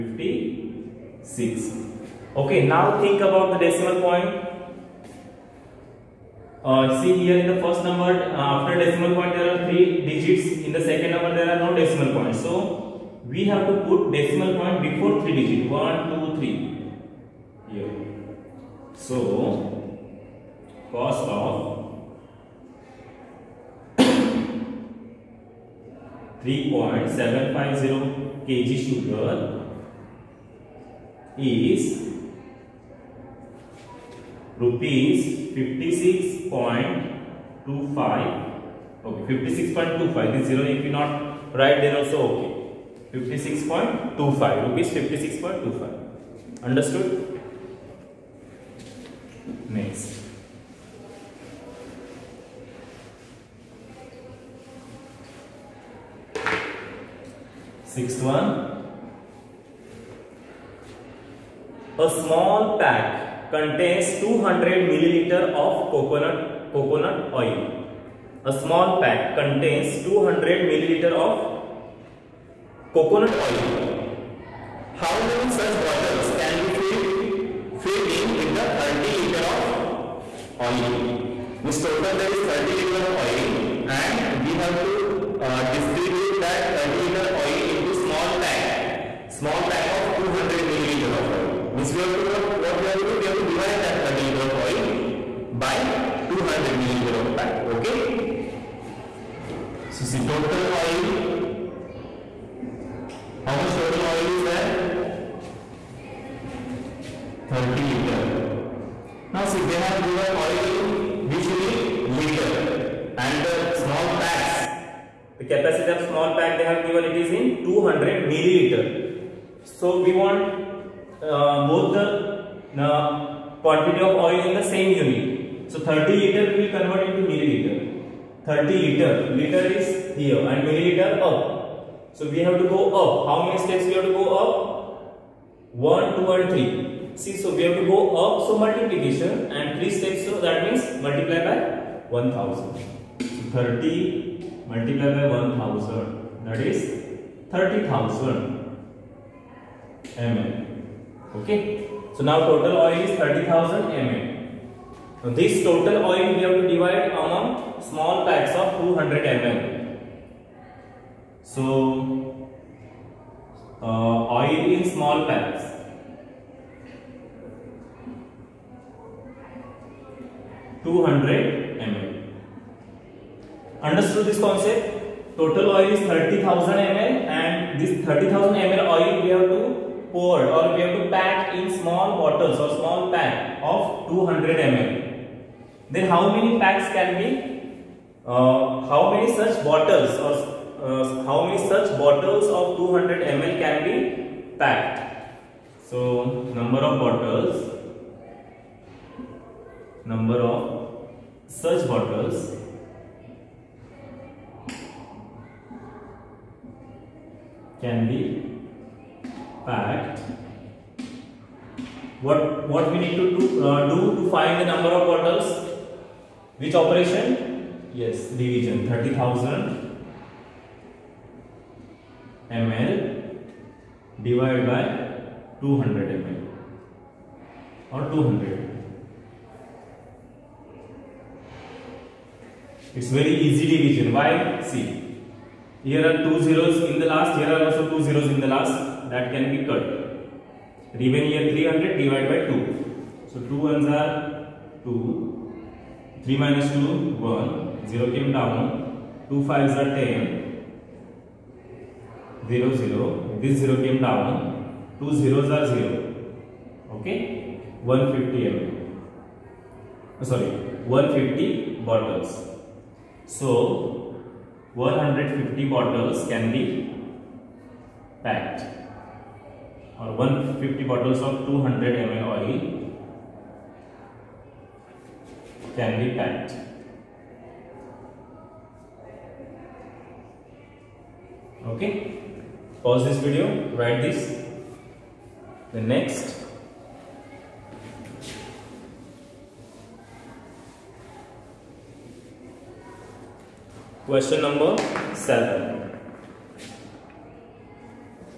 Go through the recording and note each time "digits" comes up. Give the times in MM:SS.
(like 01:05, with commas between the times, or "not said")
00:10, 00:15.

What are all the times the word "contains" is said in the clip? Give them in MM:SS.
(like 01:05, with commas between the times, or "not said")
01:03, 01:09.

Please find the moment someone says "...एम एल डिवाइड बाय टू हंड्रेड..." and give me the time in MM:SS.
03:42.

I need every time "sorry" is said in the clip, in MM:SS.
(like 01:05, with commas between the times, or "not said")
04:20.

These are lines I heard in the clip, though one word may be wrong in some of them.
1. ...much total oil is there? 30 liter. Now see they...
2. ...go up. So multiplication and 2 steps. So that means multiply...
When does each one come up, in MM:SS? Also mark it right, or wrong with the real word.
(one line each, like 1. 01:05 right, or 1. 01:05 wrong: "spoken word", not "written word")
1. 01:43 right
2. 02:17 wrong: "3", not "2".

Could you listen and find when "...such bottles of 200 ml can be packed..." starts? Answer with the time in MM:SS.
03:11.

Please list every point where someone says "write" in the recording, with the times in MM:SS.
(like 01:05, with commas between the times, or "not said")
00:41, 04:43.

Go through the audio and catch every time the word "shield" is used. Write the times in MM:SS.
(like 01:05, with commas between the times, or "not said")
not said.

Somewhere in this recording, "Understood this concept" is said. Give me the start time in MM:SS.
02:53.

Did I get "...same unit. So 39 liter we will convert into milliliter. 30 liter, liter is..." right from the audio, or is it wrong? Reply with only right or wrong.
wrong.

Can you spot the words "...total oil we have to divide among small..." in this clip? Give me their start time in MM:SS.
02:35.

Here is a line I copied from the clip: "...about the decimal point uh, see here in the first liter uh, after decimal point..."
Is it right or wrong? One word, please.
wrong.